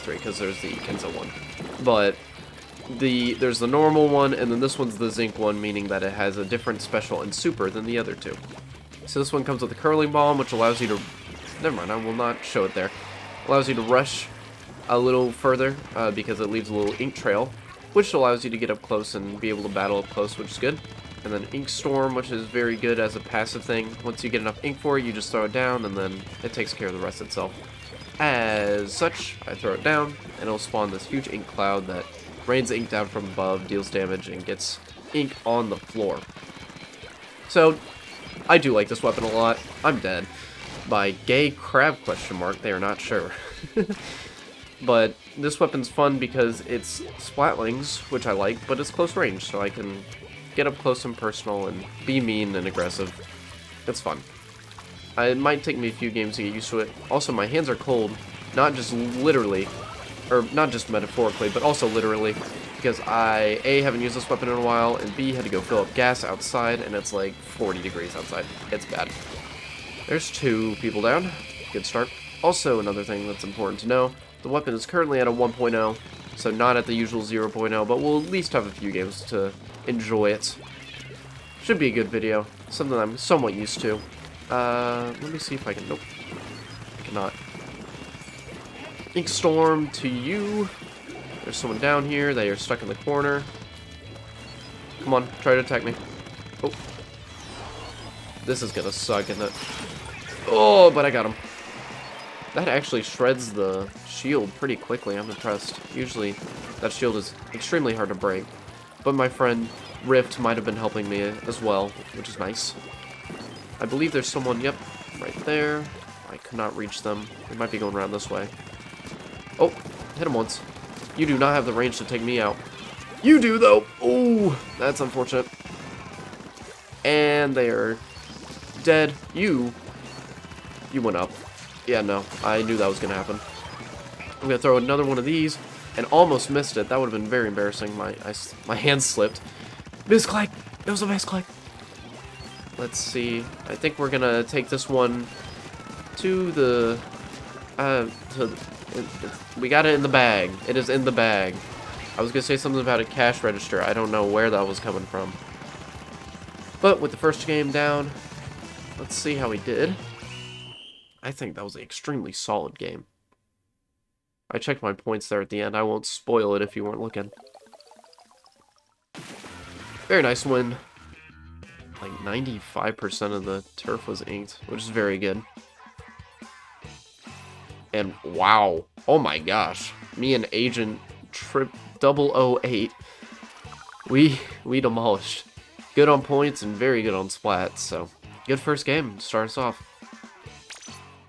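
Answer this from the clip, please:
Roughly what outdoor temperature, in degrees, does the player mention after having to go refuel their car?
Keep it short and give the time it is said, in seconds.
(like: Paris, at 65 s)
40, at 67 s.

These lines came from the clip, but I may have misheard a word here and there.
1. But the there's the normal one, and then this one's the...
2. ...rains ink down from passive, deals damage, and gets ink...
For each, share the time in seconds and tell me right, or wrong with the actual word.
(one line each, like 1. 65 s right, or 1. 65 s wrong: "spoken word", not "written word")
1. 1 s right
2. 32 s wrong: "above", not "passive".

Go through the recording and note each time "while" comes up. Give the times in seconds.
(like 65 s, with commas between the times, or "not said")
64 s.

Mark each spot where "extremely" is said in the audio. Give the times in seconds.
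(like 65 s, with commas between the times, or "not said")
107 s, 161 s.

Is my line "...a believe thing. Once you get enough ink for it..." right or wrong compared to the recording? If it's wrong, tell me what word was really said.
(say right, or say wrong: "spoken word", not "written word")
wrong: "passive", not "believe".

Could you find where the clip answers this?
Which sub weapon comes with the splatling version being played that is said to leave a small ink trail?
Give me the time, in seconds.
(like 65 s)
9 s.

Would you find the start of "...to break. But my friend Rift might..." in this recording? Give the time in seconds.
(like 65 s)
108 s.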